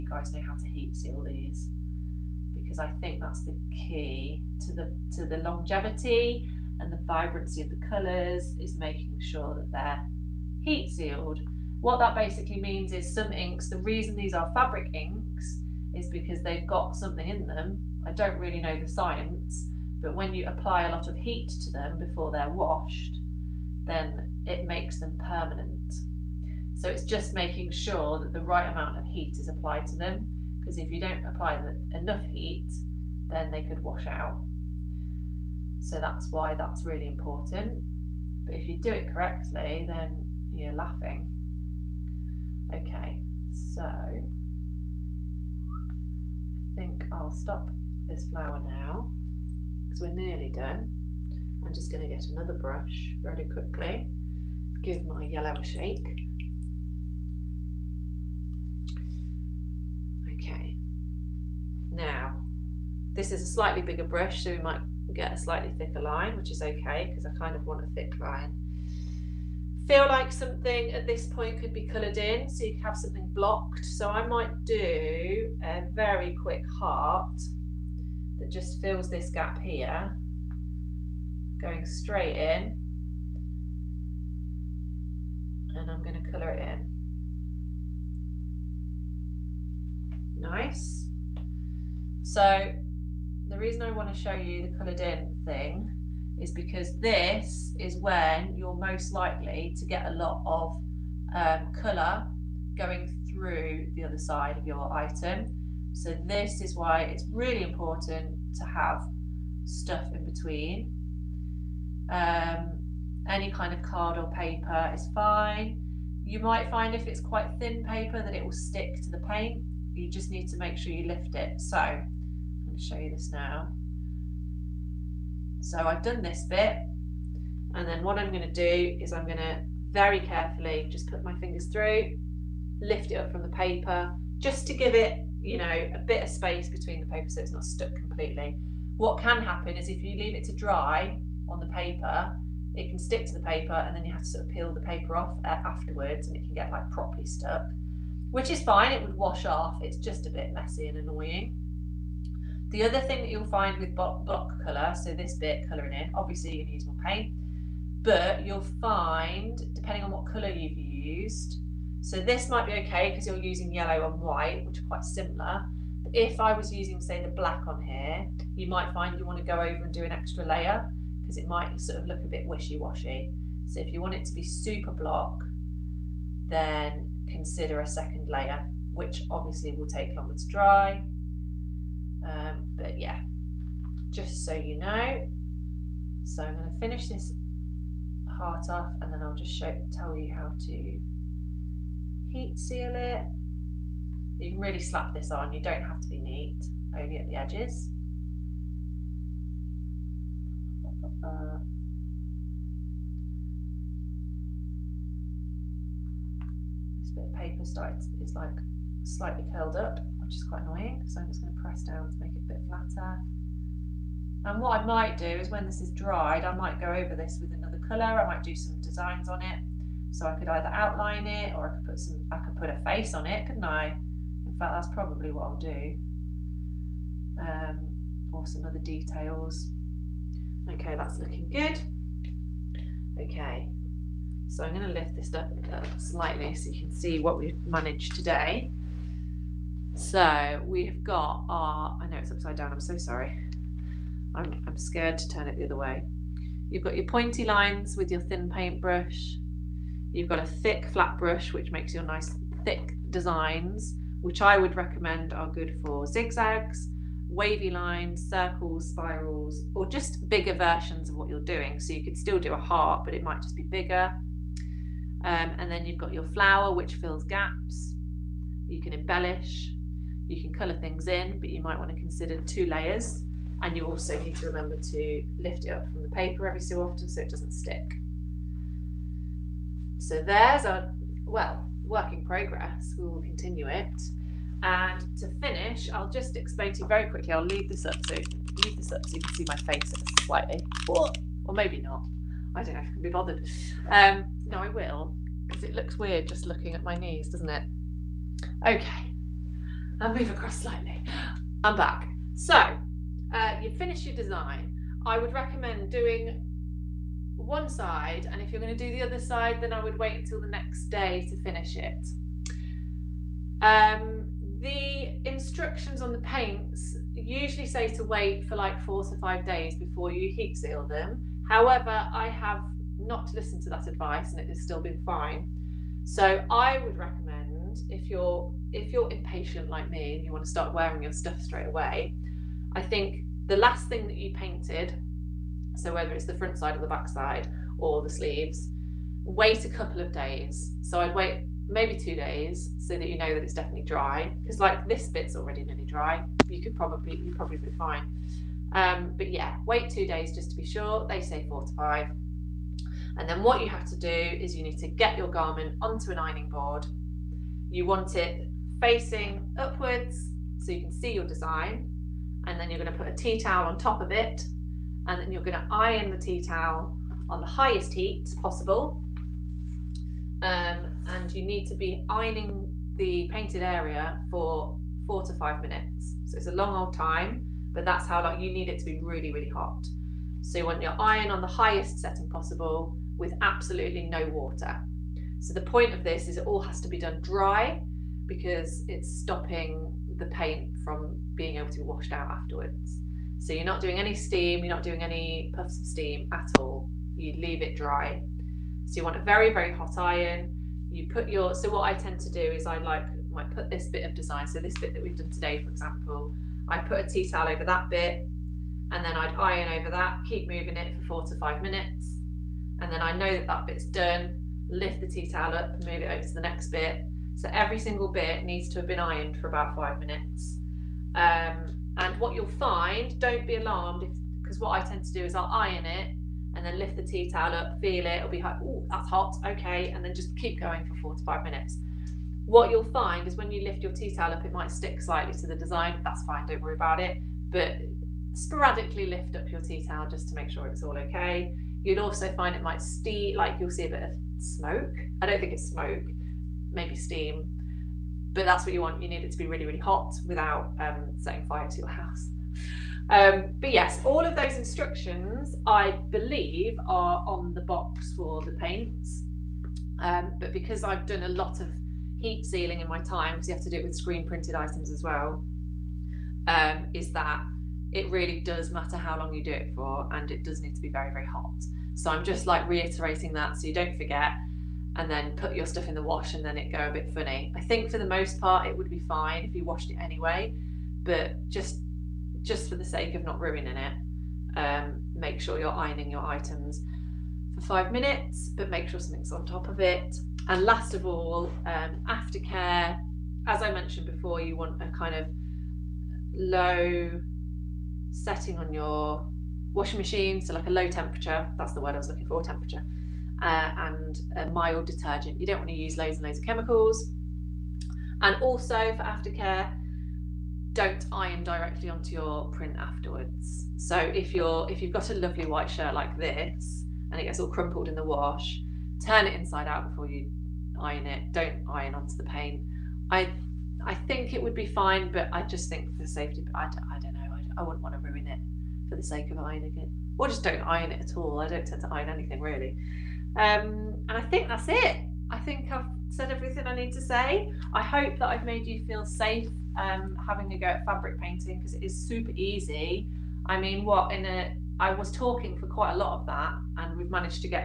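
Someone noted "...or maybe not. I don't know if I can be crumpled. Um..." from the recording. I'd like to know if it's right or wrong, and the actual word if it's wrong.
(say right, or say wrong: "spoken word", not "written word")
wrong: "bothered", not "crumpled".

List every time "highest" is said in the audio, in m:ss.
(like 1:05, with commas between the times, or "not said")
6:07, 6:21.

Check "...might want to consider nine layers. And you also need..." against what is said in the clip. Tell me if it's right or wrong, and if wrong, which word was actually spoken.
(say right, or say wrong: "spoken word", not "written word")
wrong: "two", not "nine".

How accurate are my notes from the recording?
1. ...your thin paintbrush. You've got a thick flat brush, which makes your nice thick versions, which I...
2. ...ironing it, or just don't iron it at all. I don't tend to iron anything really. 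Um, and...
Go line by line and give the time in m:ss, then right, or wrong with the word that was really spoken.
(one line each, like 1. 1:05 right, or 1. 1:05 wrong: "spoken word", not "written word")
1. 4:08 wrong: "designs", not "versions"
2. 8:49 right.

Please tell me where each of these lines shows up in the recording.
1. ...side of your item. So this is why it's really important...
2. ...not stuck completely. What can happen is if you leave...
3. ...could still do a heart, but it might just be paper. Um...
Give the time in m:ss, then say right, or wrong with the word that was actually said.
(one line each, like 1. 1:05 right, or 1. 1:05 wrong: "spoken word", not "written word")
1. 1:44 right
2. 2:17 right
3. 4:22 wrong: "bigger", not "paper".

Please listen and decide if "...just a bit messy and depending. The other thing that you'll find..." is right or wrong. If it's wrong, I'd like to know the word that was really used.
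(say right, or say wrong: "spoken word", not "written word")
wrong: "annoying", not "depending".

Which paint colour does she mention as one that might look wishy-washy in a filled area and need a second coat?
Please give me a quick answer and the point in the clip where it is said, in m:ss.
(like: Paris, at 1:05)
Black, at 2:47.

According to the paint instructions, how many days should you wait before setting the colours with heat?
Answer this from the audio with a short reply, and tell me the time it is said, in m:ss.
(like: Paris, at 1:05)
4 to 5 days, at 5:18.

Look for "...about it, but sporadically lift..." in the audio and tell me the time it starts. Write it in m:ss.
7:16.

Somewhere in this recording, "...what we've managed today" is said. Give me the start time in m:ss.
3:57.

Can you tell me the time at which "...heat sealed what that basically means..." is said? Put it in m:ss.
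0:10.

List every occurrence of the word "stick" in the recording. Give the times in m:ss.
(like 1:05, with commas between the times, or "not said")
1:58, 2:22, 4:37, 7:14.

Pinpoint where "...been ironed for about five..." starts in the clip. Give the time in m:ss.
6:58.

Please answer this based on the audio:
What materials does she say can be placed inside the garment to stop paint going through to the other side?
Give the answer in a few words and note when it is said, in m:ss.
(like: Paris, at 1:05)
Card or paper, at 1:53.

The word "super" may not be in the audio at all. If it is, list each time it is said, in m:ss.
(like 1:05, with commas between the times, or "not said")
2:54, 9:01.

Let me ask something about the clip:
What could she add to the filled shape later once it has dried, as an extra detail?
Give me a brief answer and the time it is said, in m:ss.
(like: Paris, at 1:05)
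A face, at 3:42.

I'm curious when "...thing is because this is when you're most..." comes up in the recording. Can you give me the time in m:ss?
1:35.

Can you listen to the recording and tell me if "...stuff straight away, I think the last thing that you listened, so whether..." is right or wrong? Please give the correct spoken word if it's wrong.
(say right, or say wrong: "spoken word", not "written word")
wrong: "painted", not "listened".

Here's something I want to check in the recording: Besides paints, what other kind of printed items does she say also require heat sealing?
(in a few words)
Screen printed items.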